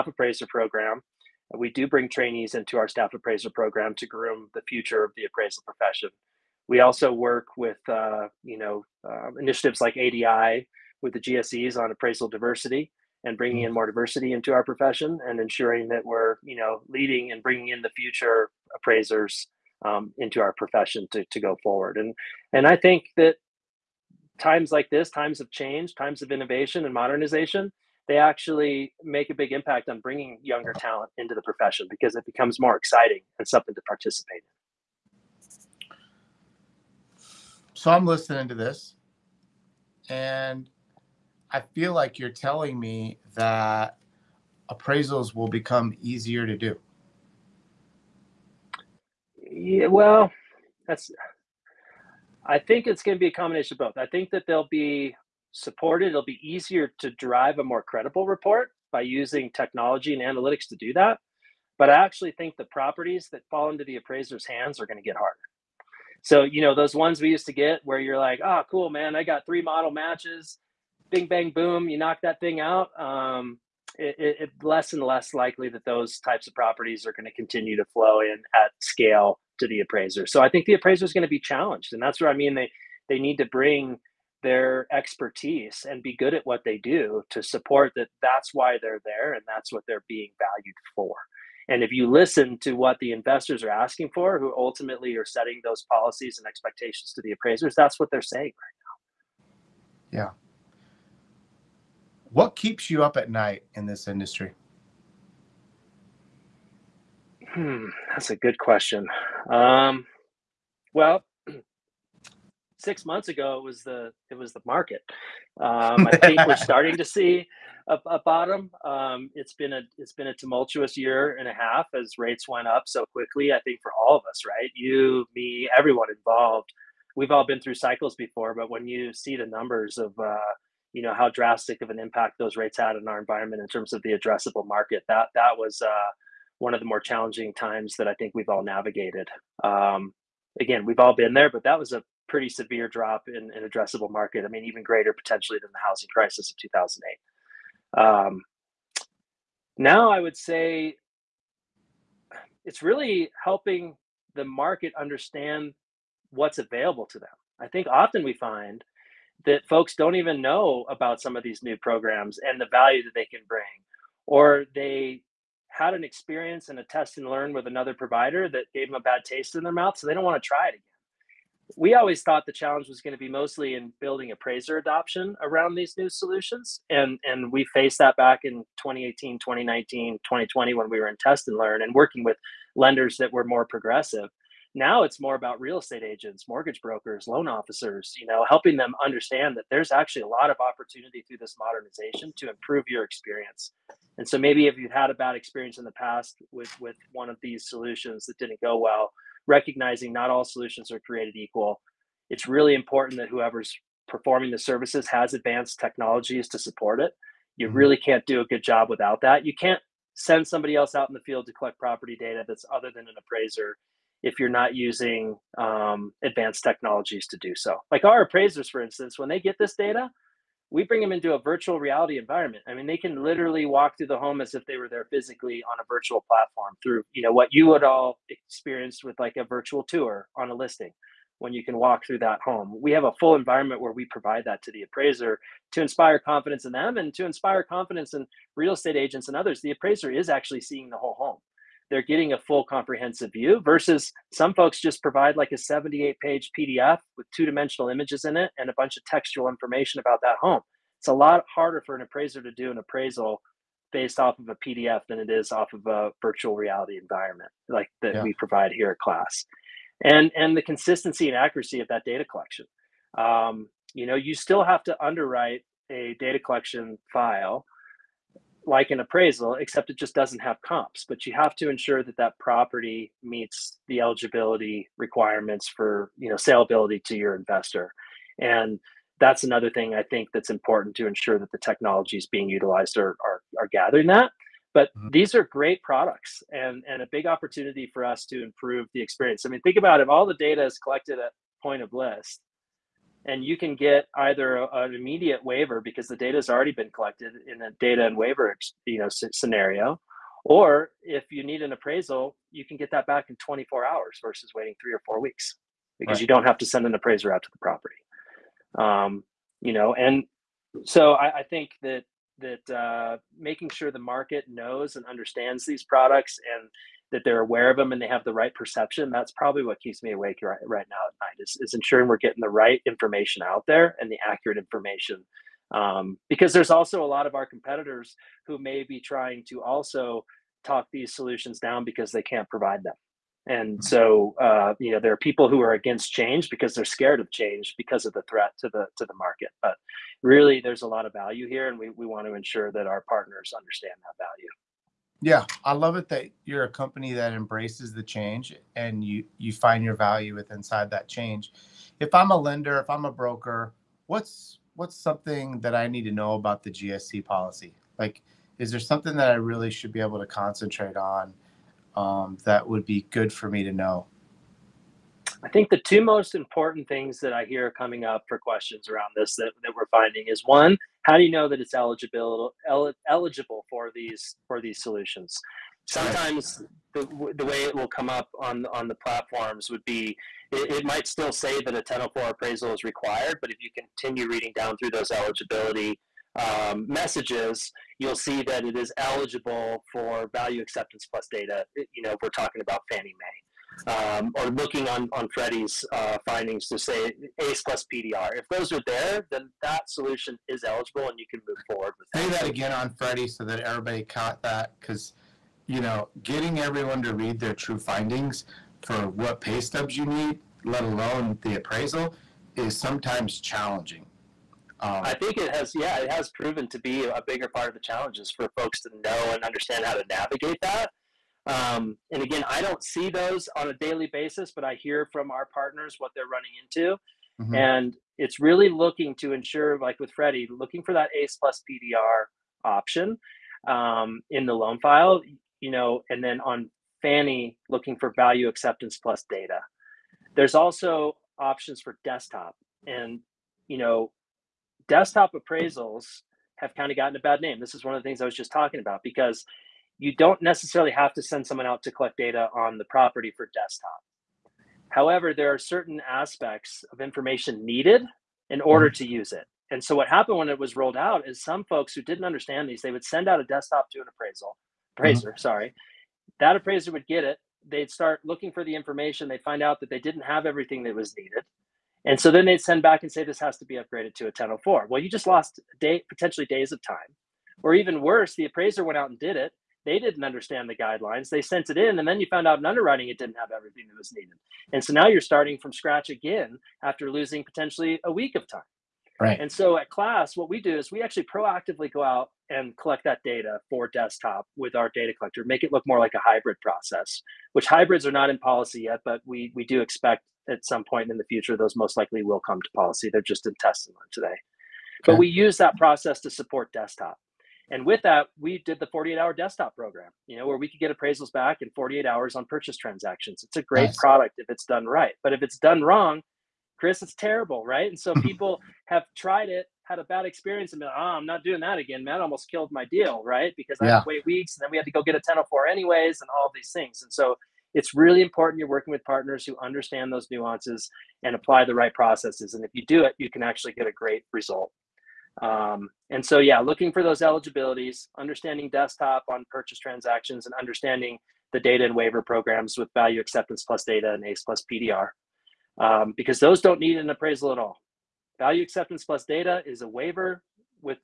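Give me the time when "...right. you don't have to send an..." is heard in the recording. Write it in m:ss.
5:06.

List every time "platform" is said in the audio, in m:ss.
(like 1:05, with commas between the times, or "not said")
3:46, 6:18.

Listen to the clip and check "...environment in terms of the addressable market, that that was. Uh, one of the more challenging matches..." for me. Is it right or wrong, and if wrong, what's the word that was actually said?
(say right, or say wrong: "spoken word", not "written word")
wrong: "times", not "matches".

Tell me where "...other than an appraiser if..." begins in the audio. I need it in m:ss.
3:32.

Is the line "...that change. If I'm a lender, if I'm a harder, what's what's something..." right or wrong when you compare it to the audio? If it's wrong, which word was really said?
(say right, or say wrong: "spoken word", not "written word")
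wrong: "broker", not "harder".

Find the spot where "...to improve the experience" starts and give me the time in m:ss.
4:48.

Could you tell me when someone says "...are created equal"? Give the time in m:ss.
3:20.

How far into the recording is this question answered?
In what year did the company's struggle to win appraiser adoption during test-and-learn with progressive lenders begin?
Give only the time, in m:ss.
2:58.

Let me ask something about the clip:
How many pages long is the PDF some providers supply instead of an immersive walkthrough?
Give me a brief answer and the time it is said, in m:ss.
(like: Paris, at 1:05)
78, at 4:05.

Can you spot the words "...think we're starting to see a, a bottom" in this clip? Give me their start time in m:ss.
1:56.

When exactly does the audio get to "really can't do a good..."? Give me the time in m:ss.
3:27.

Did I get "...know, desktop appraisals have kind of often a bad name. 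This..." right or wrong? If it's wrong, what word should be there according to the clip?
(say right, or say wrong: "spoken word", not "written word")
wrong: "gotten", not "often".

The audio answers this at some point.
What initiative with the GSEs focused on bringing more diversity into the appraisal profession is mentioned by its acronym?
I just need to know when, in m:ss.
0:09.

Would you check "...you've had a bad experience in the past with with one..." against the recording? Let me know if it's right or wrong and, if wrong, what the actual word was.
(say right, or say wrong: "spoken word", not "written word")
right.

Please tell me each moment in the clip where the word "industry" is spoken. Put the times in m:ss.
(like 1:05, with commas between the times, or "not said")
1:44.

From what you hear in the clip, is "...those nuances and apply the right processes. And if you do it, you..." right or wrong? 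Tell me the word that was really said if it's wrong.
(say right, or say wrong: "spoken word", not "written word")
right.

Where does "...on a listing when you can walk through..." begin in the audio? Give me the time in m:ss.
3:50.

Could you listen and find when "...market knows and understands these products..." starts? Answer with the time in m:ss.
5:13.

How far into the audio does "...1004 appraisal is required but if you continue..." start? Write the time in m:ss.
6:21.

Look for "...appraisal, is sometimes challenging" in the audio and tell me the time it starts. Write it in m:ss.
6:51.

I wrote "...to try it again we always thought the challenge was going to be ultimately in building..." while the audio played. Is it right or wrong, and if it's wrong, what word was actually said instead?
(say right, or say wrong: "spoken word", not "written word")
wrong: "mostly", not "ultimately".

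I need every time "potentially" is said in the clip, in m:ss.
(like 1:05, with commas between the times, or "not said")
2:25, 7:56, 8:07.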